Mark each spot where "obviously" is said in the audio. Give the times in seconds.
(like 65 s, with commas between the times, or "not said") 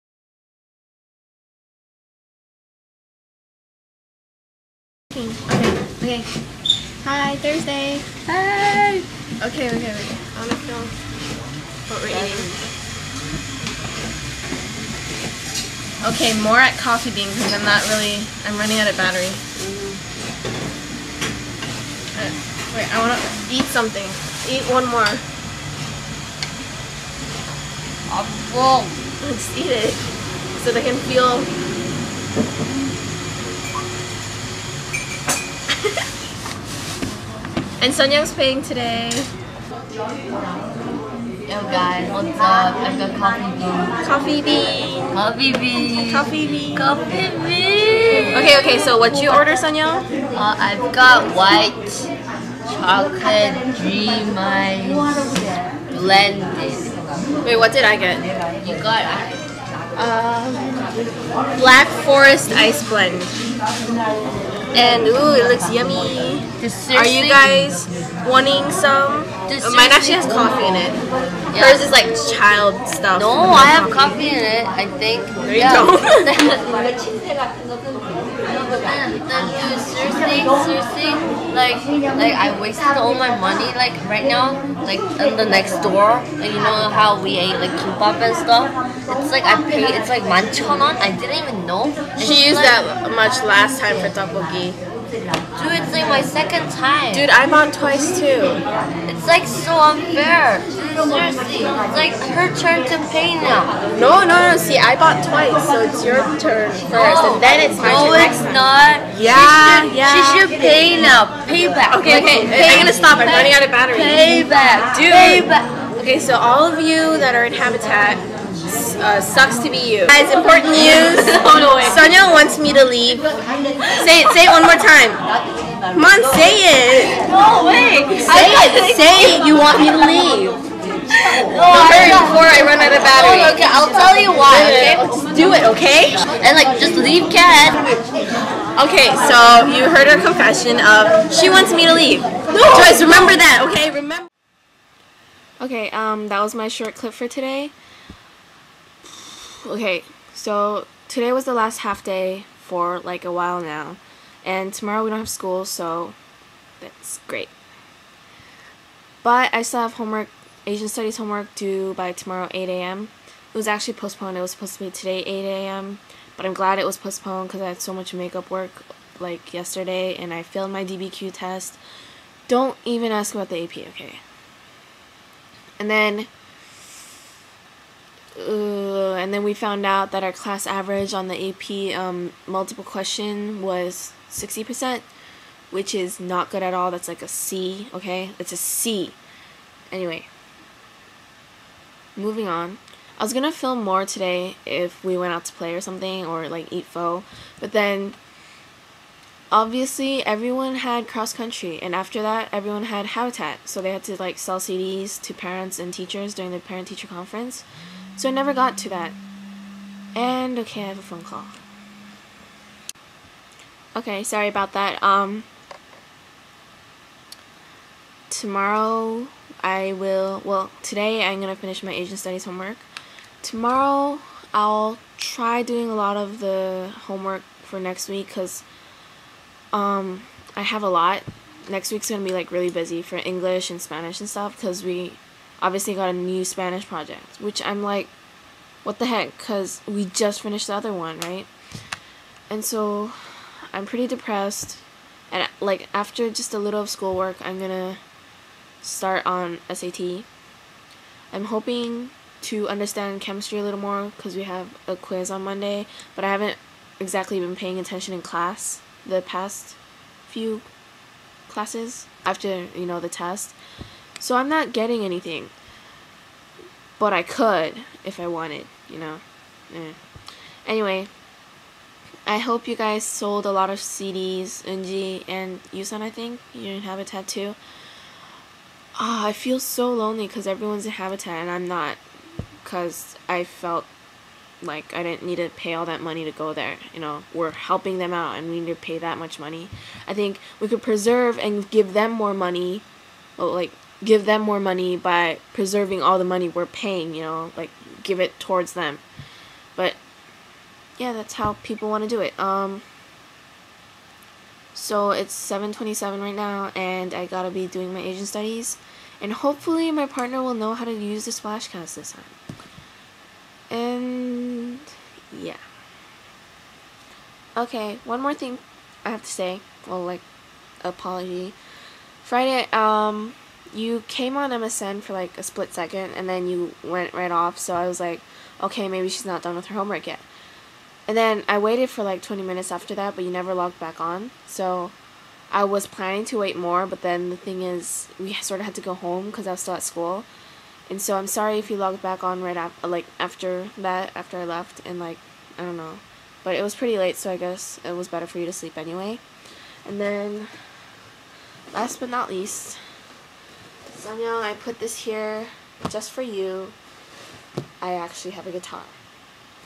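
199 s, 235 s.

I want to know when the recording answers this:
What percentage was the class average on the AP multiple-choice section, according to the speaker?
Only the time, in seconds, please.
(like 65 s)
184 s.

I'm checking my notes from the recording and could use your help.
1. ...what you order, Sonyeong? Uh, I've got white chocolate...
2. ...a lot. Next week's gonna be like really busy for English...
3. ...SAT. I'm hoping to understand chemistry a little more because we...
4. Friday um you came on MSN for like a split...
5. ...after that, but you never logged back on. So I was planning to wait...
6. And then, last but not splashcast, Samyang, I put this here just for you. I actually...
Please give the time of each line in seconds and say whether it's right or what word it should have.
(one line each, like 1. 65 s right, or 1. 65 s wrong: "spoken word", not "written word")
1. 49 s right
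2. 230 s right
3. 249 s right
4. 322 s right
5. 332 s right
6. 349 s wrong: "least", not "splashcast".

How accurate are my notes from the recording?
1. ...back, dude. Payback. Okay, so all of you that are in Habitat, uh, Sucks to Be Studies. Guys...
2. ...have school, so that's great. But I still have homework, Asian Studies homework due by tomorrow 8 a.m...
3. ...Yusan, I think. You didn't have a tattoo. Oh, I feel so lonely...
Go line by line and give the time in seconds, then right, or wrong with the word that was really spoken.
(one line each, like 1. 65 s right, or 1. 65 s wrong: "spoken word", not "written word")
1. 114 s wrong: "You", not "Studies"
2. 155 s right
3. 275 s right.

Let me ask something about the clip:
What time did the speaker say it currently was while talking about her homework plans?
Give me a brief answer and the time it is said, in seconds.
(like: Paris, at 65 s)
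7:27, at 305 s.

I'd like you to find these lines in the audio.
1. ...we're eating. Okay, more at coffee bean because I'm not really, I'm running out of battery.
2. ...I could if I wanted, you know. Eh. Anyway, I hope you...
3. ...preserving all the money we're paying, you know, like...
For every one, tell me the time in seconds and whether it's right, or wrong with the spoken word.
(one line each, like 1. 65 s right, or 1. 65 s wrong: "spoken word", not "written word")
1. 12 s right
2. 267 s right
3. 295 s right.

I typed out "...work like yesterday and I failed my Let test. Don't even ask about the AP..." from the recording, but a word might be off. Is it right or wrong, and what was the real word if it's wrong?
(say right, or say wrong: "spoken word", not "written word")
wrong: "DBQ", not "Let".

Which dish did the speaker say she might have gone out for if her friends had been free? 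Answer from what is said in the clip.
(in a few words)
Pho.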